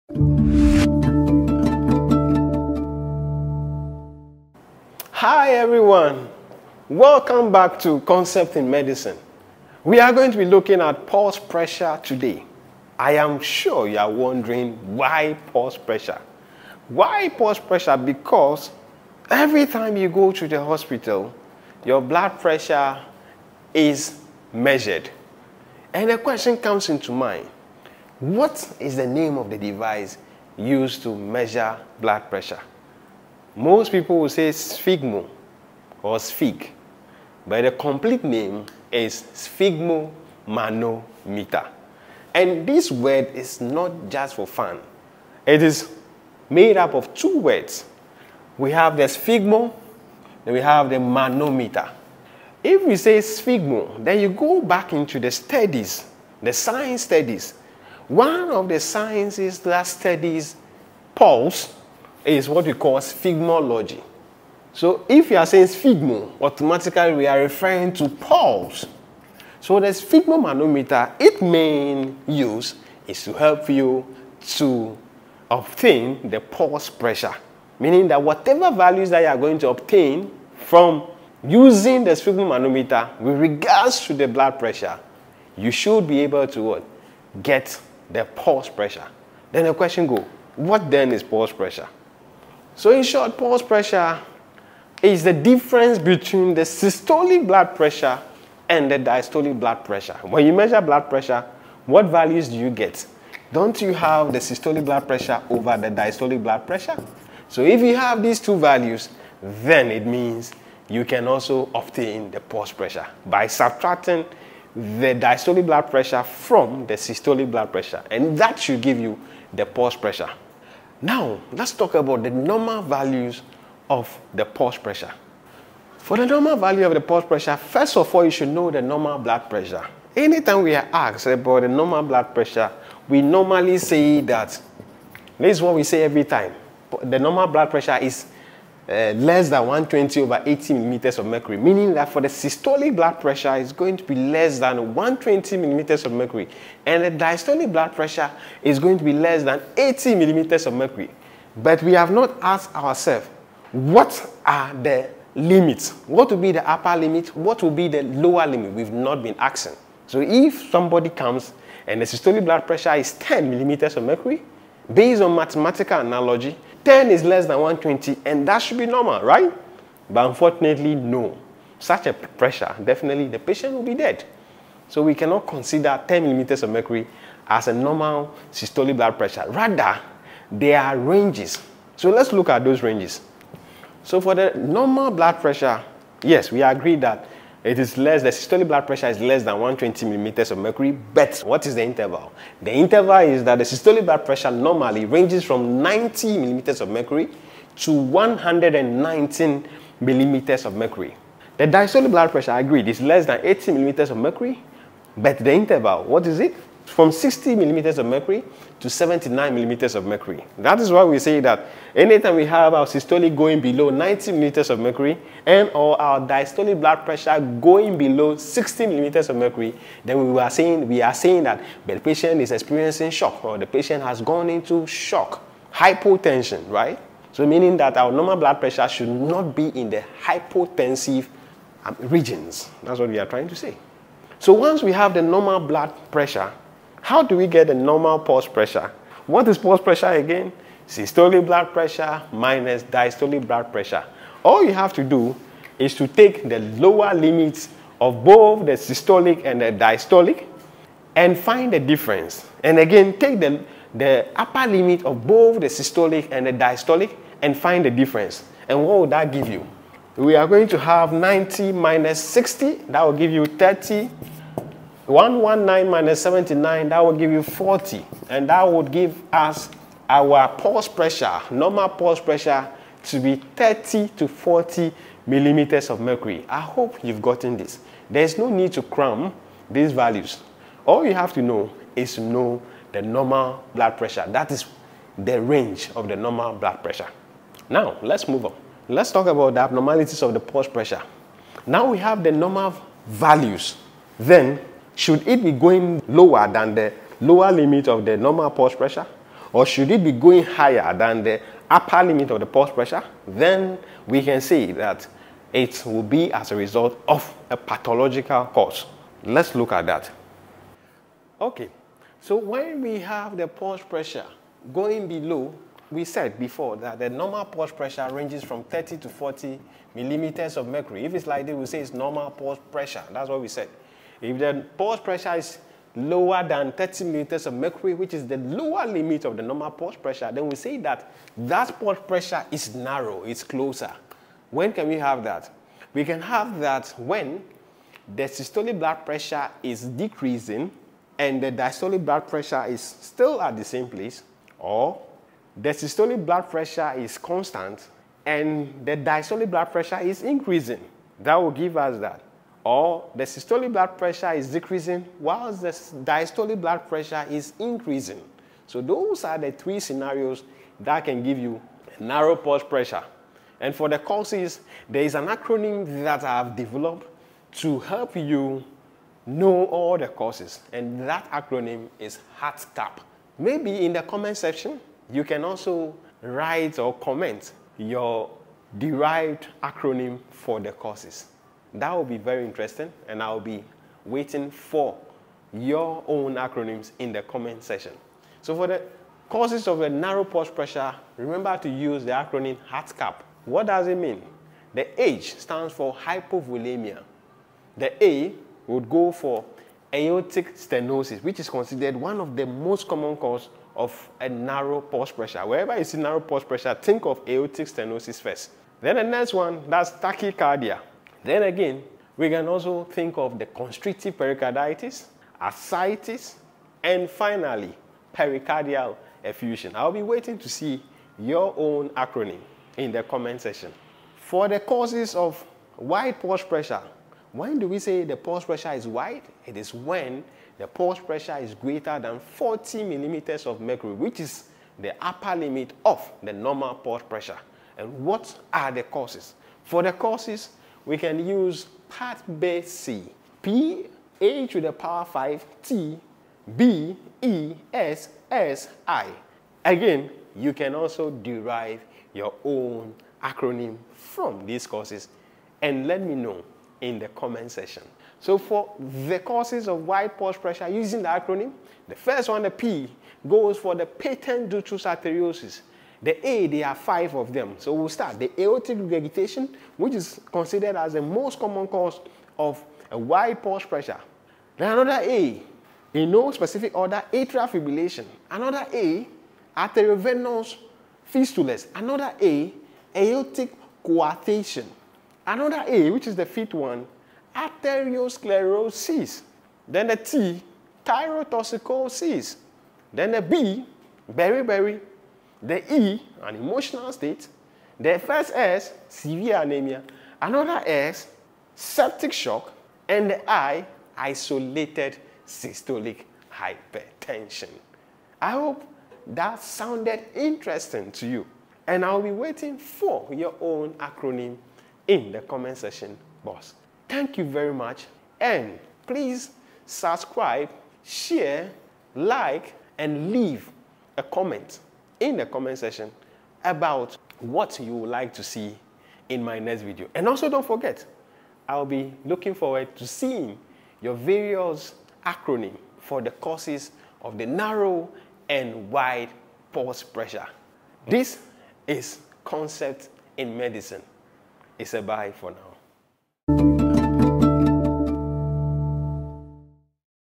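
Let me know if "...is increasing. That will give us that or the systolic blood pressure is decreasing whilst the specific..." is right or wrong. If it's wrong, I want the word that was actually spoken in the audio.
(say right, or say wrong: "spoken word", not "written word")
wrong: "diastolic", not "specific".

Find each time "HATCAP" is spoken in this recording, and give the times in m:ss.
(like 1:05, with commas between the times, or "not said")
6:12, 6:32.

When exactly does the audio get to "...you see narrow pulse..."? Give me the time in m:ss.
6:45.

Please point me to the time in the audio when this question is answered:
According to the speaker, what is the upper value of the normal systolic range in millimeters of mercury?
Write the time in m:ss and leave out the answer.
3:17.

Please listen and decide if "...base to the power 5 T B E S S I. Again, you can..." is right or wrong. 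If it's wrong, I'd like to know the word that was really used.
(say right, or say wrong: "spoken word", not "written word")
right.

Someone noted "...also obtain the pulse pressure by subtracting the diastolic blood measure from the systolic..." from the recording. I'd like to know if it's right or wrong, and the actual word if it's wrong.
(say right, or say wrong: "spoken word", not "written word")
wrong: "pressure", not "measure".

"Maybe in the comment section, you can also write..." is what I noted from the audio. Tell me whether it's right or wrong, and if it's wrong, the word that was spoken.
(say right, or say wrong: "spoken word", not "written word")
right.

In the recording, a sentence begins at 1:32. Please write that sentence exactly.
So in short, pulse pressure is the difference between the systolic blood pressure and the diastolic blood pressure.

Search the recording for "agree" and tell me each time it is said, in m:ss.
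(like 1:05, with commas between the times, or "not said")
3:06, 3:22.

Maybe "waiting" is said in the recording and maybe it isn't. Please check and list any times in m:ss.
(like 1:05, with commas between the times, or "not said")
6:24, 7:00, 8:32.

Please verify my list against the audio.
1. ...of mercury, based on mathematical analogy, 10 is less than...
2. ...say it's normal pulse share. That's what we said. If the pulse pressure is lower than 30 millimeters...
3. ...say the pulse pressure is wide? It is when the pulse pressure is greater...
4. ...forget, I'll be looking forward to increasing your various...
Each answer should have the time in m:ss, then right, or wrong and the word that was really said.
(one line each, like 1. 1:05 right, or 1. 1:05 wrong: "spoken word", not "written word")
1. 2:43 right
2. 5:21 wrong: "pressure", not "share"
3. 7:07 right
4. 8:50 wrong: "seeing", not "increasing".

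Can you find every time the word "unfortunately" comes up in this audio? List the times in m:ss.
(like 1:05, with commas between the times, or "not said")
2:50.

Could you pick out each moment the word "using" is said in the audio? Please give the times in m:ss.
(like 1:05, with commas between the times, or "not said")
1:21, 7:40.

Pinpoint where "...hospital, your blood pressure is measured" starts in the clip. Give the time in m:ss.
0:20.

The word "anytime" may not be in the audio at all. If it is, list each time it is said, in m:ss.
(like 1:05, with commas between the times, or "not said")
2:10, 3:31.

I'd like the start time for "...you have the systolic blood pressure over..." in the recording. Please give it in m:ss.
1:43.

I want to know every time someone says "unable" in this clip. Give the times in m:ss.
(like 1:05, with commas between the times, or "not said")
not said.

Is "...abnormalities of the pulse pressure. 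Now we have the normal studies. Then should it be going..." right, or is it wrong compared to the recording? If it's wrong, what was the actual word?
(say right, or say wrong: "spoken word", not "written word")
wrong: "values", not "studies".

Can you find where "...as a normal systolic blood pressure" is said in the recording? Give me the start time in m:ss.
2:57.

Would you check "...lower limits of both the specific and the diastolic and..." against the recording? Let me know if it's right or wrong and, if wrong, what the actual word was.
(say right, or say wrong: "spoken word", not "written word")
wrong: "systolic", not "specific".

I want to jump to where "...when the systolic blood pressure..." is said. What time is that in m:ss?
5:36.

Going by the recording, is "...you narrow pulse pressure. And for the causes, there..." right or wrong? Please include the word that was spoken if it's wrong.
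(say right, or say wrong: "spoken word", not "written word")
right.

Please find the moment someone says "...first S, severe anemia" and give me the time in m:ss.
8:17.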